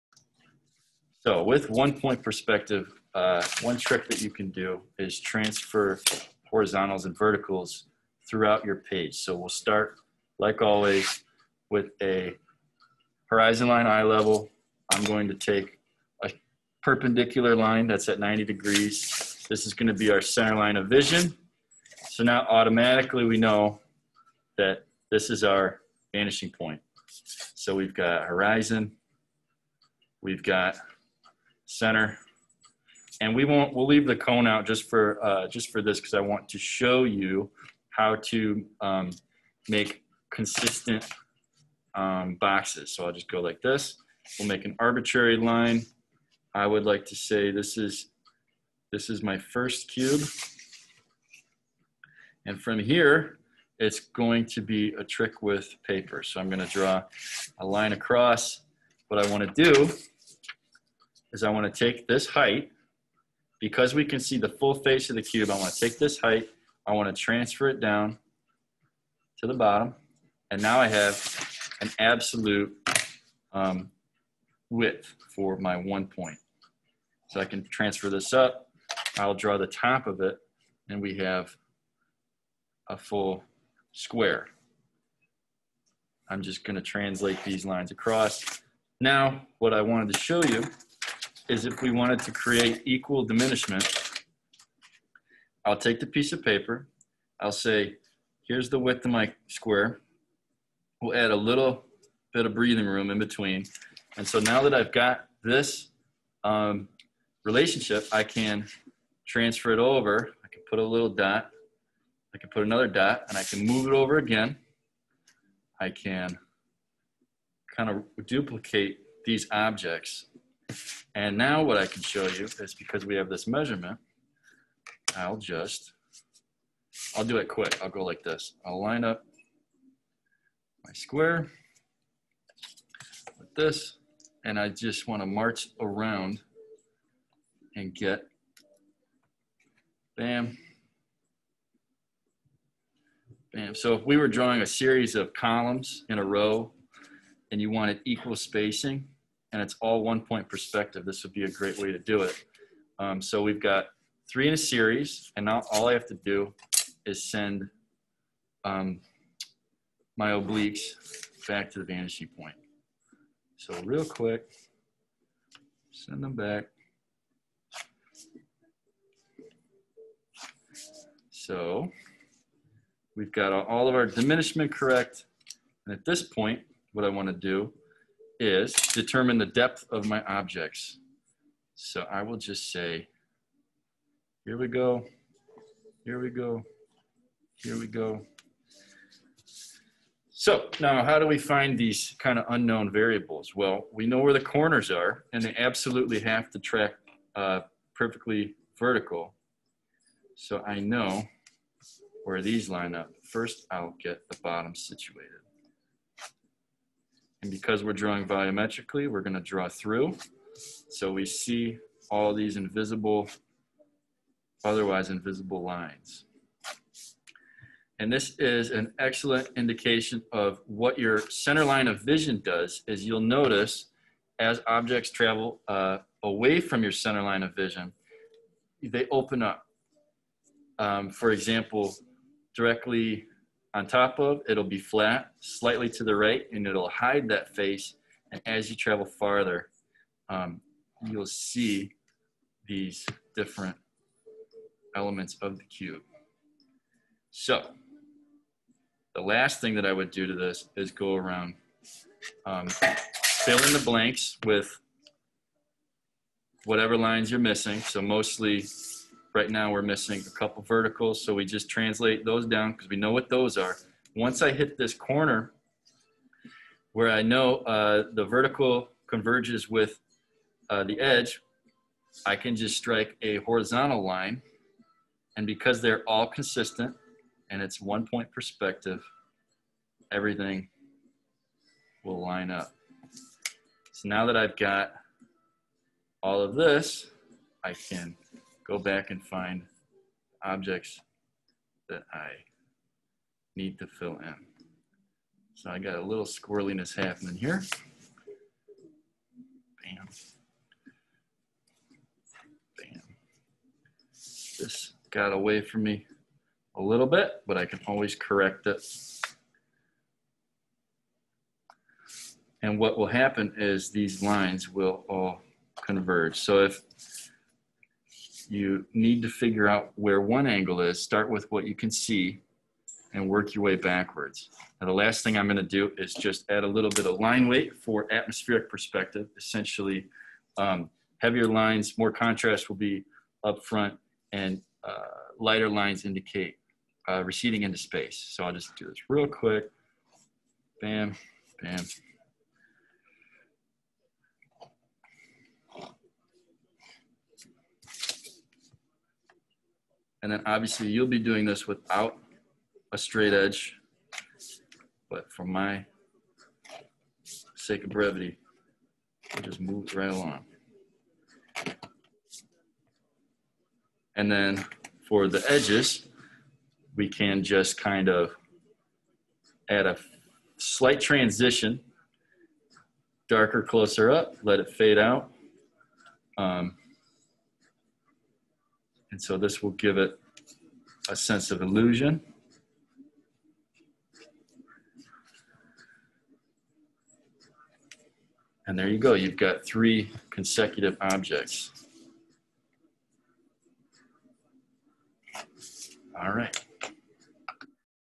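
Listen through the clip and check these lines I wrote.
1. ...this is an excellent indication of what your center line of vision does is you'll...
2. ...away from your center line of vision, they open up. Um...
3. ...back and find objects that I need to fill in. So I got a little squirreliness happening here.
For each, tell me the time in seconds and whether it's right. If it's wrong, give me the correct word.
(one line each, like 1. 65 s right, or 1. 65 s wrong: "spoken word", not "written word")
1. 218 s right
2. 226 s right
3. 288 s right.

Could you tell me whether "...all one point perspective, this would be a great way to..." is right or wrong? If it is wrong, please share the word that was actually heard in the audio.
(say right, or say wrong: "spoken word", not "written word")
right.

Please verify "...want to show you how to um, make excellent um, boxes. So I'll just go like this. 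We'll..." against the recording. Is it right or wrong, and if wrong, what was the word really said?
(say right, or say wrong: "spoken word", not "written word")
wrong: "consistent", not "excellent".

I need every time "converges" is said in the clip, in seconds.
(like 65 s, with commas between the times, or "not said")
269 s, 315 s.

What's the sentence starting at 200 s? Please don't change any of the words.
So I know where these line up.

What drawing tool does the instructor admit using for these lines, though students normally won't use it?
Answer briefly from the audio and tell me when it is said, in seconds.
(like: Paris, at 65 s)
straight edge, at 352 s.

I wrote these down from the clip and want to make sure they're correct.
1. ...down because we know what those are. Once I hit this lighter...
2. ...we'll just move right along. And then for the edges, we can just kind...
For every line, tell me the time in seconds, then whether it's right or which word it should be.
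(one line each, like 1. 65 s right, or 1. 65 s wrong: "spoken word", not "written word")
1. 262 s wrong: "corner", not "lighter"
2. 359 s right.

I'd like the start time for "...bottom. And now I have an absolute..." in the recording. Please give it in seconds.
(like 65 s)
69 s.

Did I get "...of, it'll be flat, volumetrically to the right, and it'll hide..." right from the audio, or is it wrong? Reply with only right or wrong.
wrong.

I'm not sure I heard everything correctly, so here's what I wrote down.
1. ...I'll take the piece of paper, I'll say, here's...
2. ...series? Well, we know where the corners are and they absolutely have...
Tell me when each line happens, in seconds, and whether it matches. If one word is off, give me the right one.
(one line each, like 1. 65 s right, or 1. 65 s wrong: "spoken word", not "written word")
1. 95 s right
2. 192 s wrong: "variables", not "series".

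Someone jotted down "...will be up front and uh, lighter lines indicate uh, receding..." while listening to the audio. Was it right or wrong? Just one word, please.
right.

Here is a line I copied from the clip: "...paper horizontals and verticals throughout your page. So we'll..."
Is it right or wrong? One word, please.
wrong.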